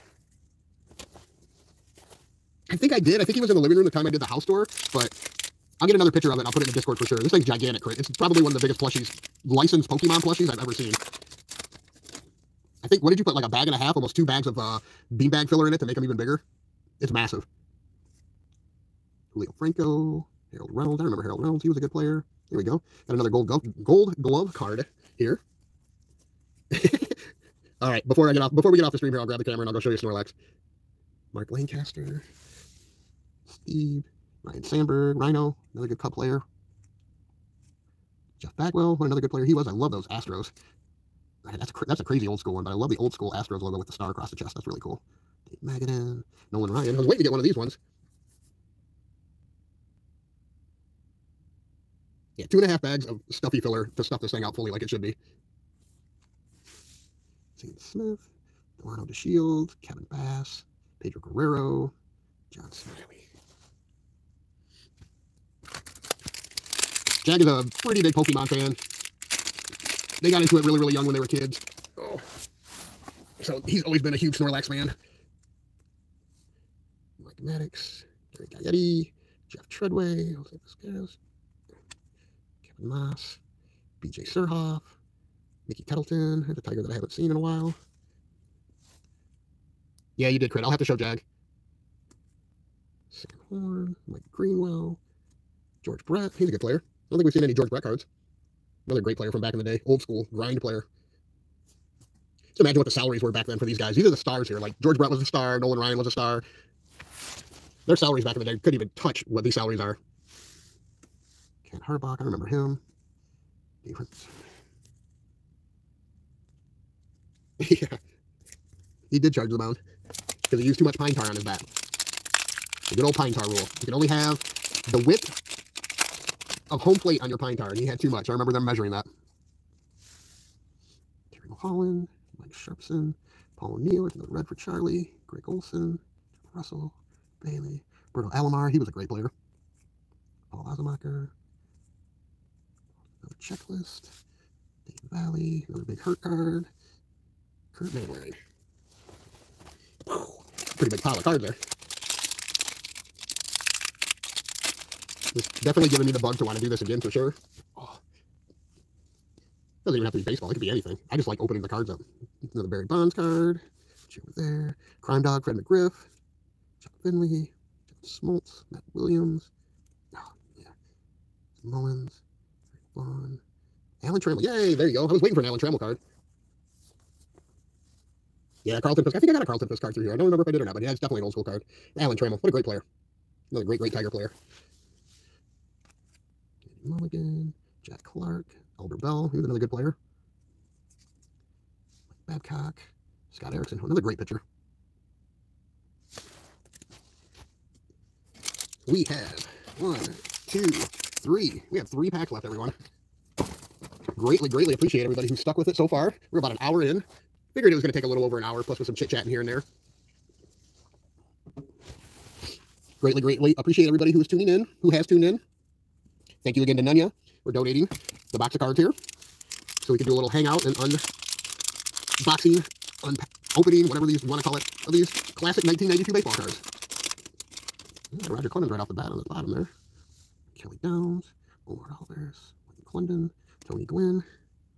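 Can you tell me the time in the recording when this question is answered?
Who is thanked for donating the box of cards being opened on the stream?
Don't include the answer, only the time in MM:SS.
03:36.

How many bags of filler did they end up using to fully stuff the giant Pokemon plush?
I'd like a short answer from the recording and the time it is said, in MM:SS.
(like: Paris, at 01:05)
2 and a half, at 00:52.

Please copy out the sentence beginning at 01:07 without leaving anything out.
Jag is a pretty big Pokemon fan.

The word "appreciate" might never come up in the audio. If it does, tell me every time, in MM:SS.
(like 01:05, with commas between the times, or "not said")
03:24, 03:33.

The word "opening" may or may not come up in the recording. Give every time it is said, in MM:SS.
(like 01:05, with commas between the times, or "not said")
02:41, 03:43.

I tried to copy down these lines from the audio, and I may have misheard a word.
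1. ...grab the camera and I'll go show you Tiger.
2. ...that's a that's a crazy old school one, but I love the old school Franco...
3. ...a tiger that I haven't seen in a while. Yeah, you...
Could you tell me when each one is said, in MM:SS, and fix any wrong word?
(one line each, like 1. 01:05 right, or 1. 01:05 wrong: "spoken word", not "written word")
1. 00:29 wrong: "Snorlax", not "Tiger"
2. 00:41 wrong: "Astros", not "Franco"
3. 01:26 right.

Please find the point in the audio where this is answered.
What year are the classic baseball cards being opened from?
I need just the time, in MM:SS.
03:45.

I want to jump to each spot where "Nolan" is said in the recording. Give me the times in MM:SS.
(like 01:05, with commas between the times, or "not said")
00:46, 01:45.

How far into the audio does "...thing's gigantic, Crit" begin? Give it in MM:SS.
00:07.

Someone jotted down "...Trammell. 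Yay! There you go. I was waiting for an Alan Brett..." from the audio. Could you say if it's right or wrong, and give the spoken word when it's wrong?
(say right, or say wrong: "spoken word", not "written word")
wrong: "Trammell", not "Brett".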